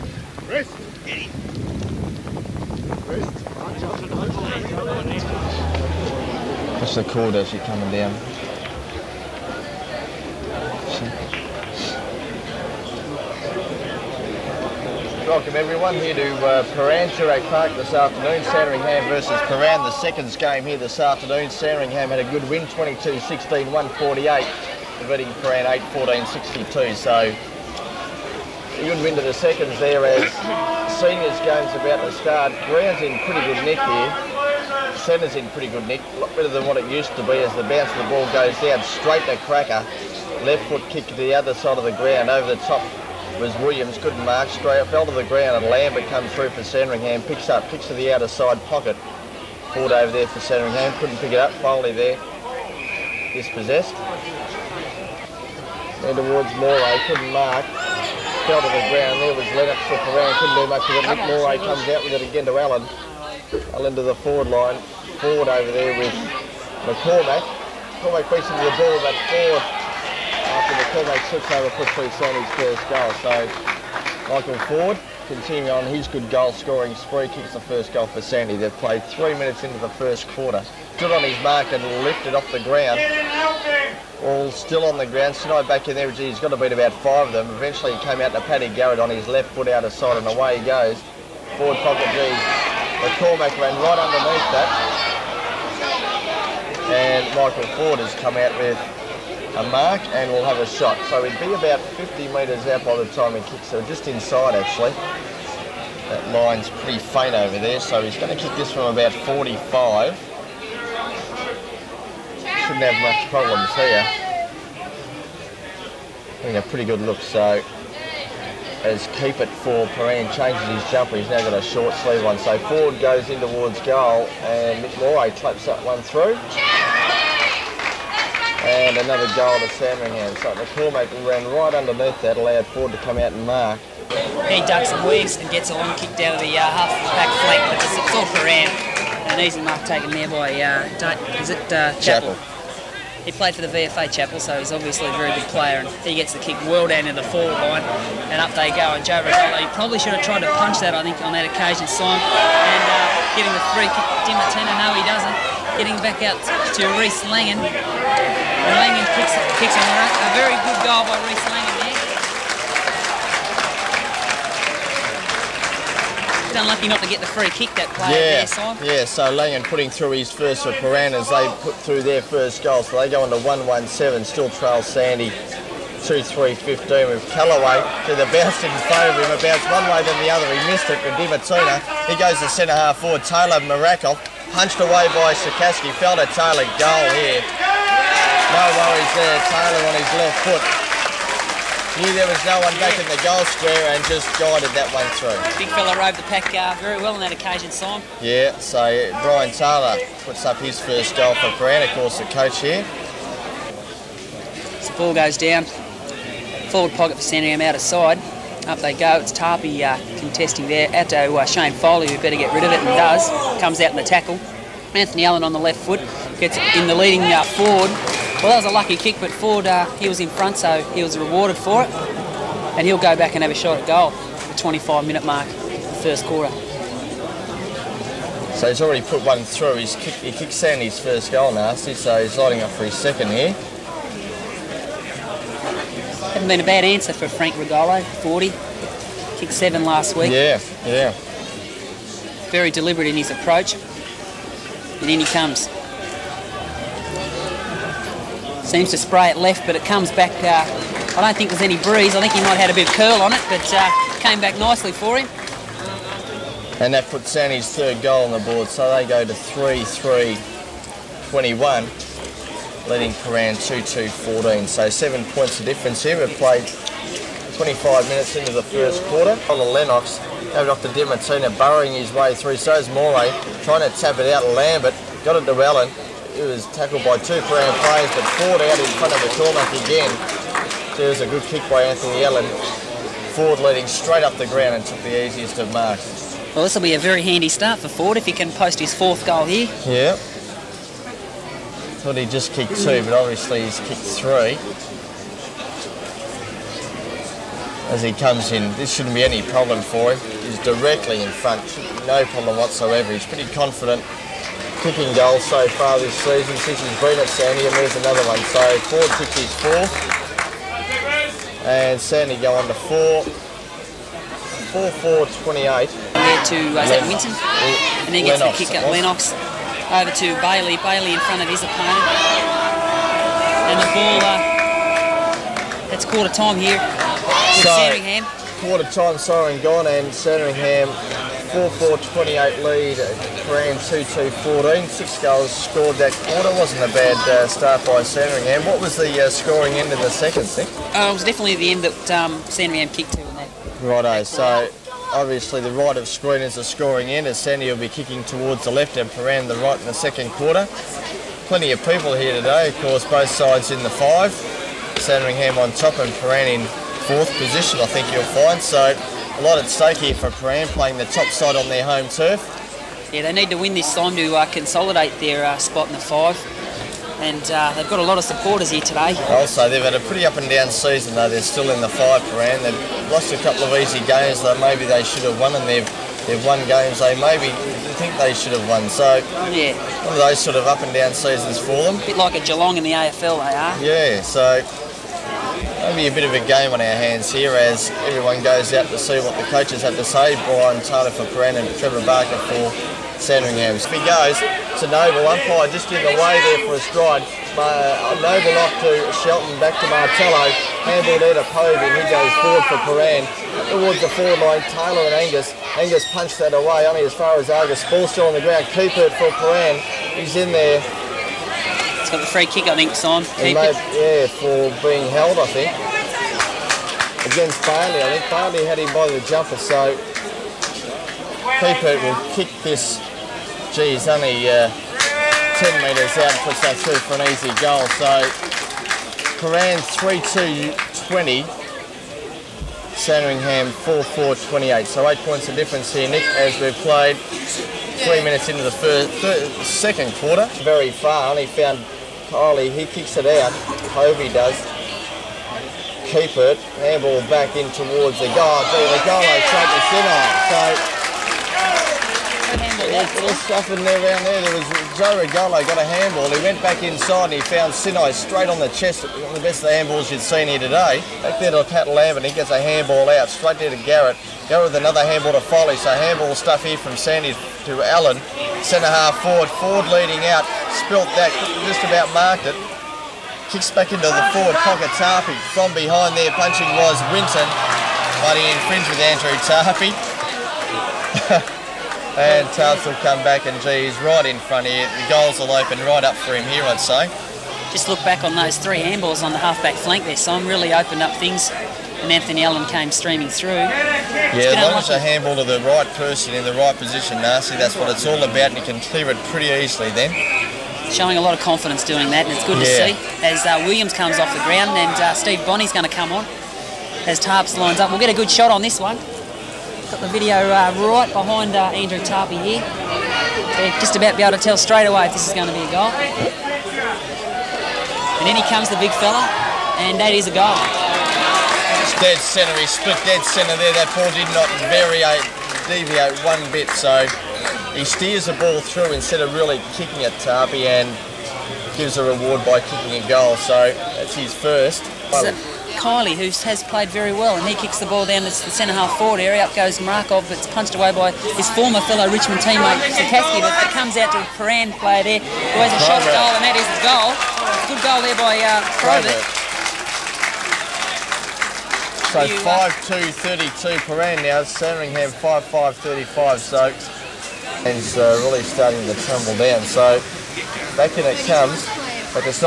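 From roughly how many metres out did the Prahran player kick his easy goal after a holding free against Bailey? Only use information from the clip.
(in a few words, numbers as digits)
10.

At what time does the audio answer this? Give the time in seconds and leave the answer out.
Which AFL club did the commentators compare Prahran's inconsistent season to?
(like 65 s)
382 s.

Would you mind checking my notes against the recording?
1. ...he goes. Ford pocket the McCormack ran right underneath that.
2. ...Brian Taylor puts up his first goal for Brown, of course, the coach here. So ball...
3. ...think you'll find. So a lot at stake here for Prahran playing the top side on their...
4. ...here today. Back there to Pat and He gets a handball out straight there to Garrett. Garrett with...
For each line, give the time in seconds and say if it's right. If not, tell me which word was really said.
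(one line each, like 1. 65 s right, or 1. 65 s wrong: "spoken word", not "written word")
1. 90 s right
2. 199 s right
3. 357 s right
4. 460 s right.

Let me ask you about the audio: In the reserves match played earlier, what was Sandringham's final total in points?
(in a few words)
148.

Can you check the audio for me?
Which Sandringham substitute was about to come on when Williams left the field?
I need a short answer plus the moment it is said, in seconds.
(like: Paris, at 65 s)
Steve Bonney, at 505 s.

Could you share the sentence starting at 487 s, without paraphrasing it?
Just look back on those three handballs on the halfback flank there.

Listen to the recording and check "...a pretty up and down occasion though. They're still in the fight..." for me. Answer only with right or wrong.
wrong.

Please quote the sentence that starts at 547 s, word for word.
Good goal there by uh, So 5-2-32 uh, Peran now, Sandringham 5-5-35, so and uh, really starting to tumble down.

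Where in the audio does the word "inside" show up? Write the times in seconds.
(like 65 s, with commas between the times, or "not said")
104 s, 456 s.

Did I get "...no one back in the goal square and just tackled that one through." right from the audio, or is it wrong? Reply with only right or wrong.
wrong.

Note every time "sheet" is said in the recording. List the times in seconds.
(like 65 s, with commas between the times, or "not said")
not said.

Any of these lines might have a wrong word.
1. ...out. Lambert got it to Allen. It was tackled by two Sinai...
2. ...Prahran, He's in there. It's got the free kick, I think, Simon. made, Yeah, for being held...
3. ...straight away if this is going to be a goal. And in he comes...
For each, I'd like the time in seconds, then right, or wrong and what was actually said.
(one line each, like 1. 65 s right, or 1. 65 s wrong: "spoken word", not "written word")
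1. 274 s wrong: "Prahran", not "Sinai"
2. 409 s right
3. 514 s right.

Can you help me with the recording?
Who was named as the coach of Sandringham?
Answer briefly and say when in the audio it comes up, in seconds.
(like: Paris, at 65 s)
Trevor Barker, at 391 s.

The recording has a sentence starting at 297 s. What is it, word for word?
As he comes in, this shouldn't be any problem for him.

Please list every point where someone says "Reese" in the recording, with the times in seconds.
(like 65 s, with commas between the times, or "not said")
156 s, 161 s.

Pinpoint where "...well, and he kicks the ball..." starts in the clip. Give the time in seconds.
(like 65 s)
537 s.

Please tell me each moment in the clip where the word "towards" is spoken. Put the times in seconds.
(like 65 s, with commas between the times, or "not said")
56 s, 123 s, 348 s, 403 s, 447 s.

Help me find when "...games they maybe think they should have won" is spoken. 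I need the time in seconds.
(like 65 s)
376 s.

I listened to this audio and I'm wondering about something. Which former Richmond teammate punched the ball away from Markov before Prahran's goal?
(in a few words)
Sikorsky.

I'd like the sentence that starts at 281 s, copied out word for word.
was a good kick by Anthony Allen.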